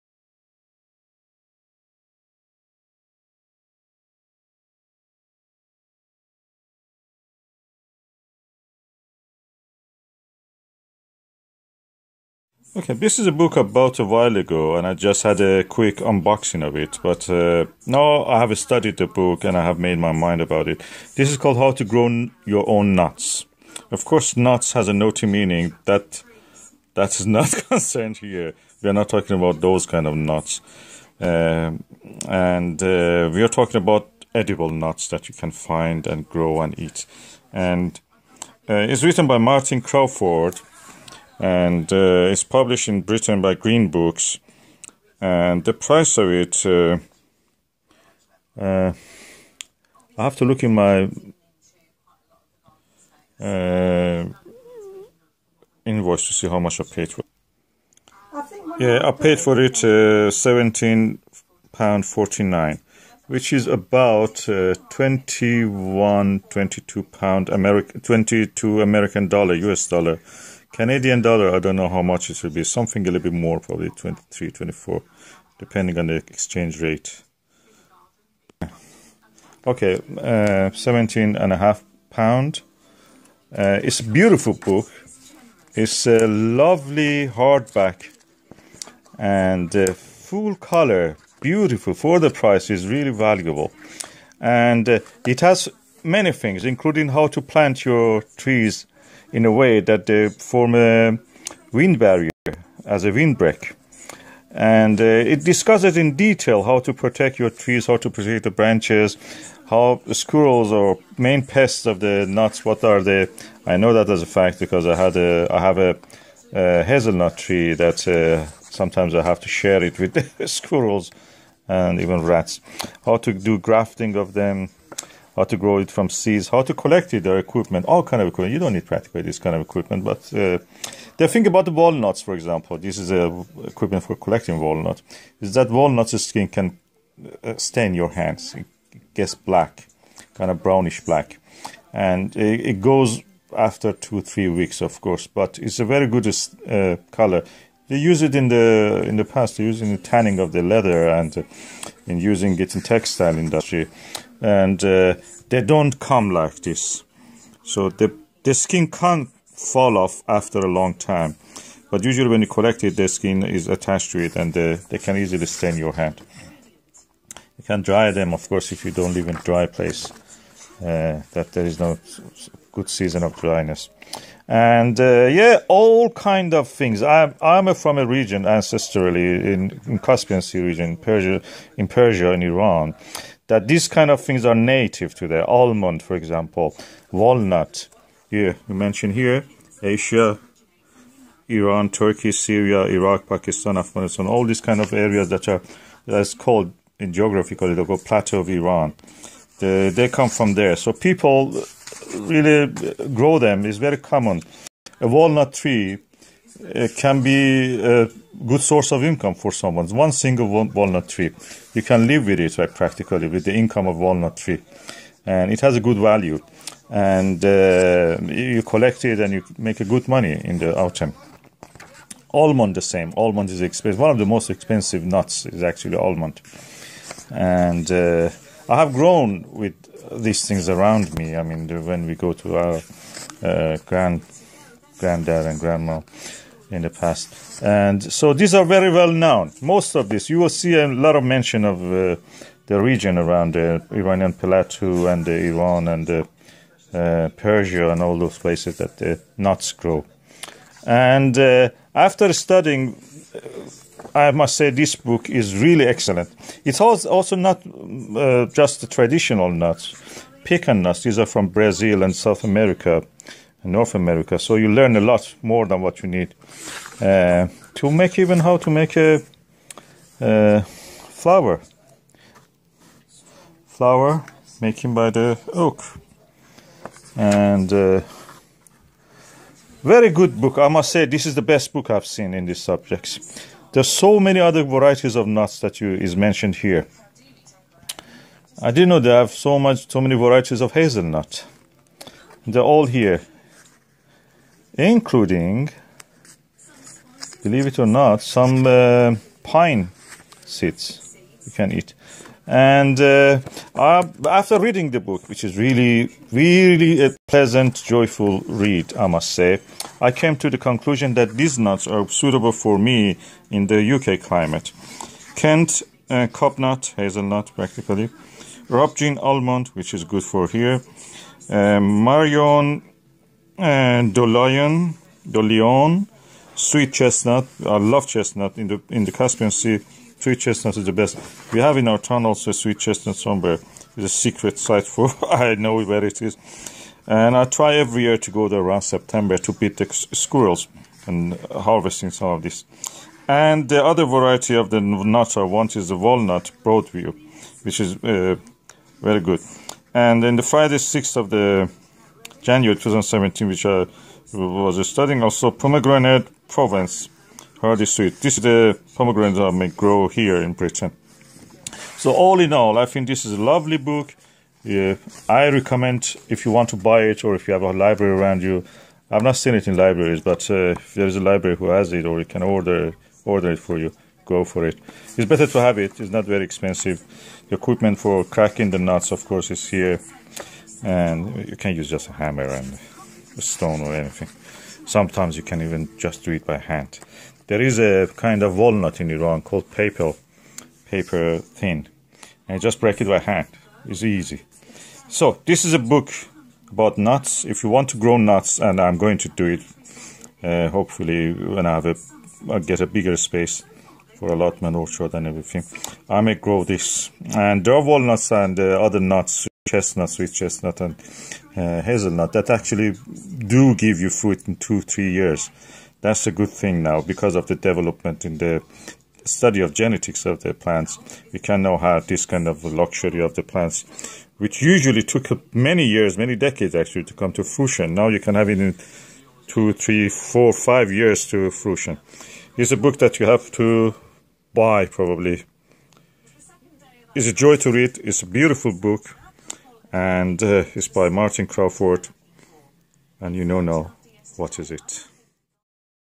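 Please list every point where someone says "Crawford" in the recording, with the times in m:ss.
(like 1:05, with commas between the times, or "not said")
0:39, 7:21.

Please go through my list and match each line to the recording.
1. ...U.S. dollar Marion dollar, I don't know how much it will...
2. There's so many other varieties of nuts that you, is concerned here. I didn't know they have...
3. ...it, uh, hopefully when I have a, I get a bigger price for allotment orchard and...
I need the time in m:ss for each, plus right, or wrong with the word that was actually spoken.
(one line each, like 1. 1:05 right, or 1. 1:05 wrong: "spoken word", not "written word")
1. 1:09 wrong: "Canadian", not "Marion"
2. 4:43 wrong: "mentioned", not "concerned"
3. 6:39 wrong: "space", not "price".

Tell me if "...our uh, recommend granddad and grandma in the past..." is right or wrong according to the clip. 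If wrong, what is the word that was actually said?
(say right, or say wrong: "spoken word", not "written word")
wrong: "grand", not "recommend".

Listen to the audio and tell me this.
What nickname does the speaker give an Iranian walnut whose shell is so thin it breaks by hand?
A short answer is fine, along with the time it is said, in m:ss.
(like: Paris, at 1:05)
paper thin, at 6:30.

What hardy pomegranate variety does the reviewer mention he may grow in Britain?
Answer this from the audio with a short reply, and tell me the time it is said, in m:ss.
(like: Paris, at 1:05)
Provence hardy sweet, at 5:56.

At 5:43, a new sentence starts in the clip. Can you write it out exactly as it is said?
And the other variety of the nuts I want is the walnut Broadview, which is uh, very good.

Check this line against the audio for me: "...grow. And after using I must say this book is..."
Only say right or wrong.
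wrong.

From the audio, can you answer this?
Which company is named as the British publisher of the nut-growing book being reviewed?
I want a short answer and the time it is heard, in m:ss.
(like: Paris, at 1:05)
Green Books, at 0:43.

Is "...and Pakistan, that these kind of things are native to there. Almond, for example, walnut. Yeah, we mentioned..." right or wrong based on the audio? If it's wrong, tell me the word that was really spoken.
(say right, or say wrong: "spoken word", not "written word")
wrong: "Iran", not "Pakistan".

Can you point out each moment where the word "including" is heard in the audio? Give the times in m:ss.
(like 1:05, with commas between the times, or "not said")
1:36, 4:54.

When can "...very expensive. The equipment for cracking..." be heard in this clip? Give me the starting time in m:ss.
6:16.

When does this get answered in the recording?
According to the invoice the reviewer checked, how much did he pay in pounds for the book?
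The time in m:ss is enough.
1:00.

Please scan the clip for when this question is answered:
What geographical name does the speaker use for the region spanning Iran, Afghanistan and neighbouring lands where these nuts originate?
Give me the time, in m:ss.
3:18.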